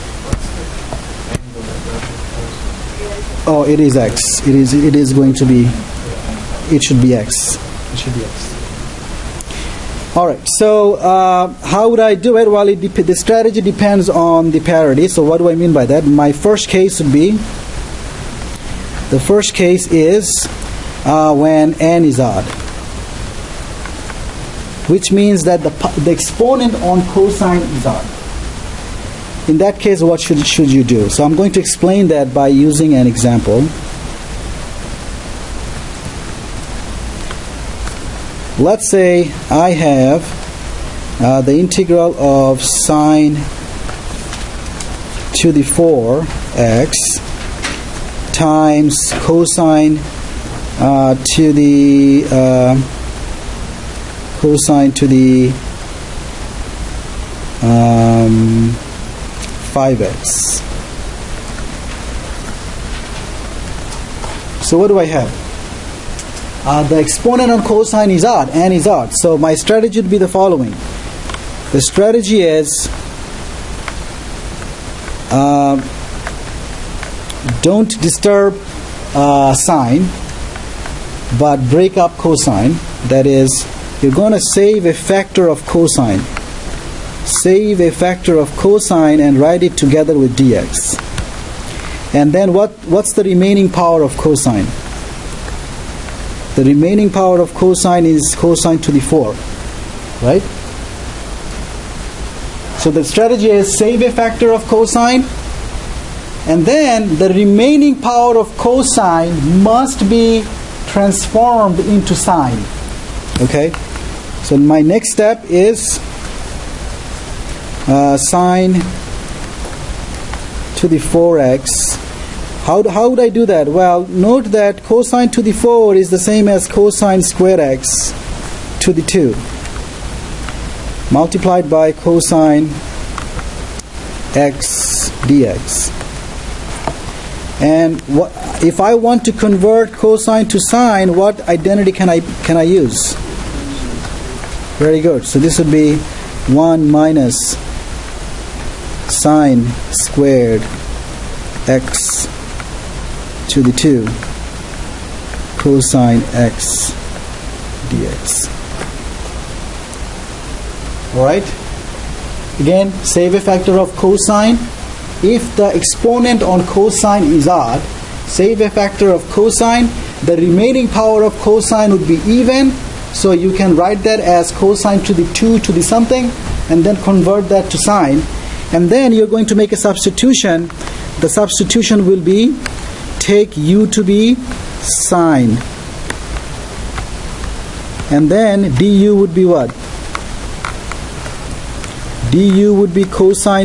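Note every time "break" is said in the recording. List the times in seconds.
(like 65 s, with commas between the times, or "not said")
81 s.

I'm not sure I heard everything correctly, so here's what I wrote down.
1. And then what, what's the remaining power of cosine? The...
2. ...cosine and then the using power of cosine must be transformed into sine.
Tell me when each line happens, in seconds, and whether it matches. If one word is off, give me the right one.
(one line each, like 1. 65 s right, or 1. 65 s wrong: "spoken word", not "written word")
1. 92 s right
2. 104 s wrong: "remaining", not "using".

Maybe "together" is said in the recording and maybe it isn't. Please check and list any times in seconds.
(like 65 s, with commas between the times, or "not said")
89 s.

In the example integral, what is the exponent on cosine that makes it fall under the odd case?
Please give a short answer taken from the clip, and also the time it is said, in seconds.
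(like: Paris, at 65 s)
5, at 59 s.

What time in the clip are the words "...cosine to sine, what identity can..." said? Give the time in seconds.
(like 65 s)
139 s.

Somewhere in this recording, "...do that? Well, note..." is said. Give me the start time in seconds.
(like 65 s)
123 s.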